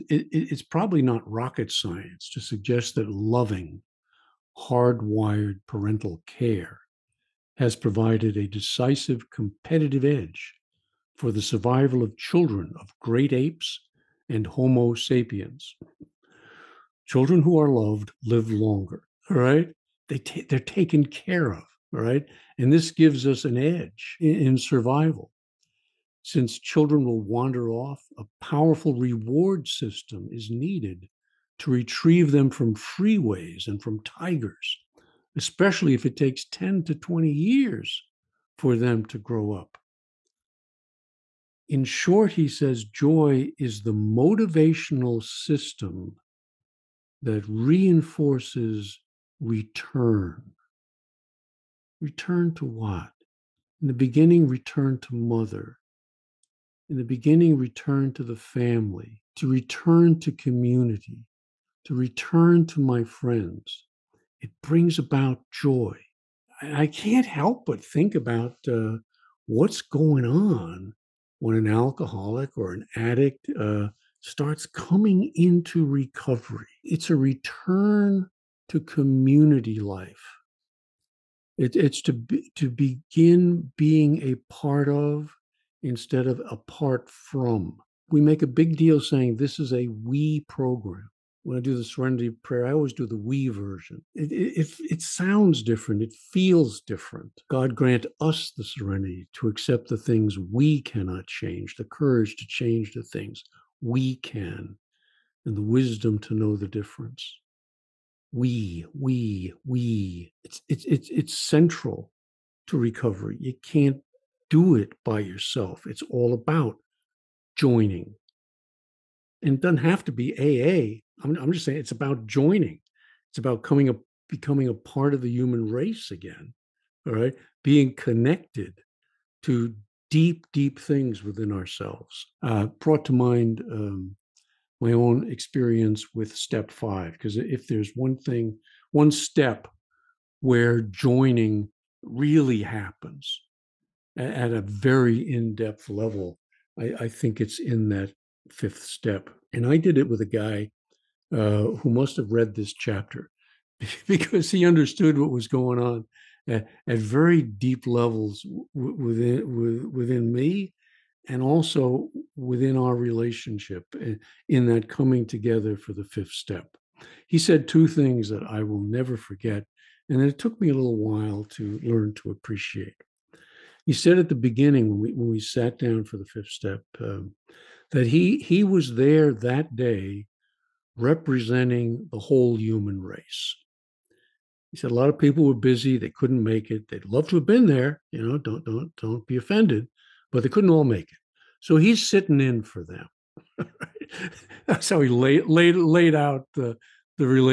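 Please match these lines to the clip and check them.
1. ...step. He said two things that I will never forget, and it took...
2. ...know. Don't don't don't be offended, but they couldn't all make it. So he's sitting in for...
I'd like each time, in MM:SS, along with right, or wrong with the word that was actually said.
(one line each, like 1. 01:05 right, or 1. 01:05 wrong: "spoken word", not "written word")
1. 02:46 right
2. 03:08 right.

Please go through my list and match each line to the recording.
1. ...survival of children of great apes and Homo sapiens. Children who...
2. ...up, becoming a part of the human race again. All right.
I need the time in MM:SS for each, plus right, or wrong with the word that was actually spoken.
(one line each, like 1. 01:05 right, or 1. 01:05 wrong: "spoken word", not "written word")
1. 00:11 right
2. 02:03 right.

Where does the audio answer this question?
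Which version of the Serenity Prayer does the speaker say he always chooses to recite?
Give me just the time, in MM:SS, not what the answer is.
01:33.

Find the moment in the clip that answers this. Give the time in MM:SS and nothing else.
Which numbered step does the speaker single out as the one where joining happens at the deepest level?
02:16.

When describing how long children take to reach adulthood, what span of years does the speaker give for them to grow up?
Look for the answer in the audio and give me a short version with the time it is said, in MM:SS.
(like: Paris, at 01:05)
10 to 20 years, at 00:36.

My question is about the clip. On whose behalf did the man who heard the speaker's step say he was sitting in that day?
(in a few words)
The whole human race.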